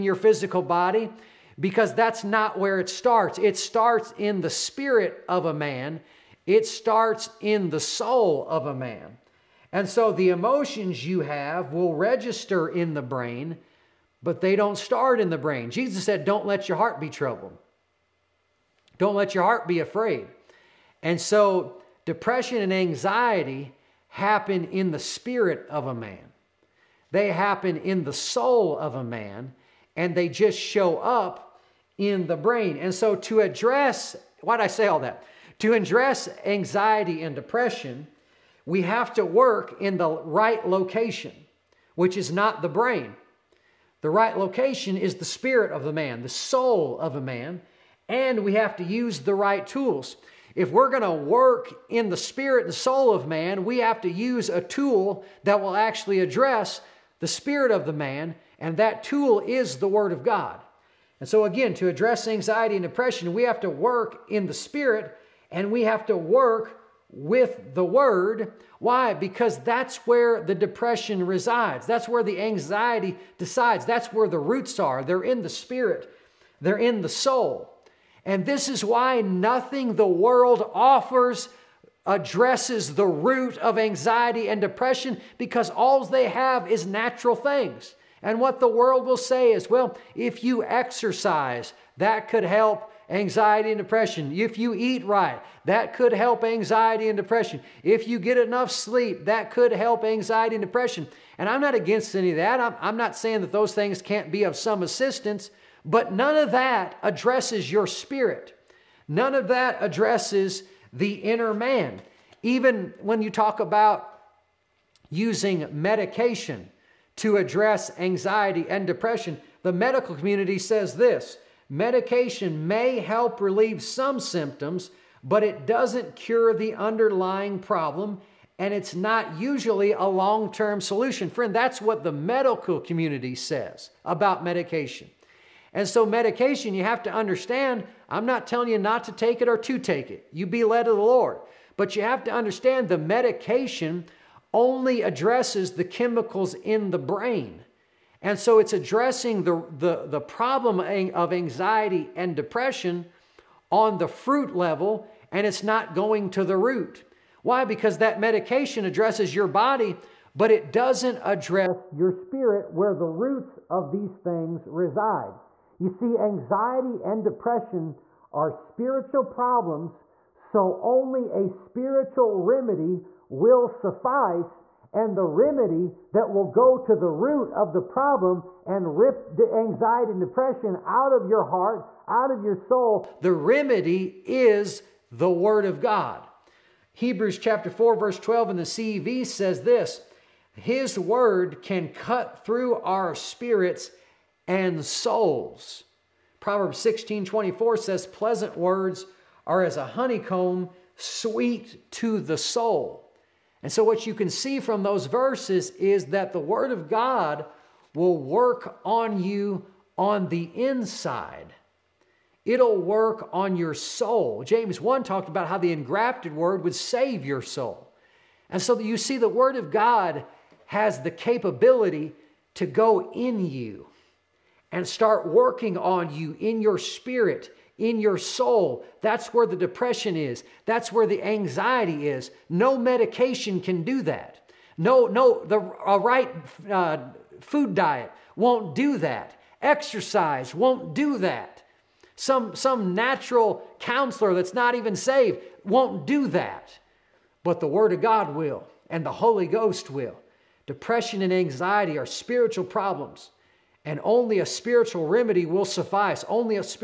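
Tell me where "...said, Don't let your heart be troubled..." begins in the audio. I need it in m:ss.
0:16.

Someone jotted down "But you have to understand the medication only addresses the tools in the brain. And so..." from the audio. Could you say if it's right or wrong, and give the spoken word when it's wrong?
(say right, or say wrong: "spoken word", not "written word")
wrong: "chemicals", not "tools".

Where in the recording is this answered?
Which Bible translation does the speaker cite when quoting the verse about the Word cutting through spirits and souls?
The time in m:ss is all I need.
3:08.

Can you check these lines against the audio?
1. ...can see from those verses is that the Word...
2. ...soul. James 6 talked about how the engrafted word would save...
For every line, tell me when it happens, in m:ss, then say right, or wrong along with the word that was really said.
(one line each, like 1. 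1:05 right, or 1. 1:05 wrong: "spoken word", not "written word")
1. 3:24 right
2. 3:33 wrong: "1", not "6".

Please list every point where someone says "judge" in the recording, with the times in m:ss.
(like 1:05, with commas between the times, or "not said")
not said.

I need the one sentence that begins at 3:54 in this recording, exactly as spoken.
No, no, the a right uh, food diet won't do that.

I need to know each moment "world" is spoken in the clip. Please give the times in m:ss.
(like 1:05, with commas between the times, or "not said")
1:20, 1:28.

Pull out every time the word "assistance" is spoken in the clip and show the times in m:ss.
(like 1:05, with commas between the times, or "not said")
1:44.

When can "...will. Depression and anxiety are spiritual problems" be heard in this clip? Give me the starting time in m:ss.
4:09.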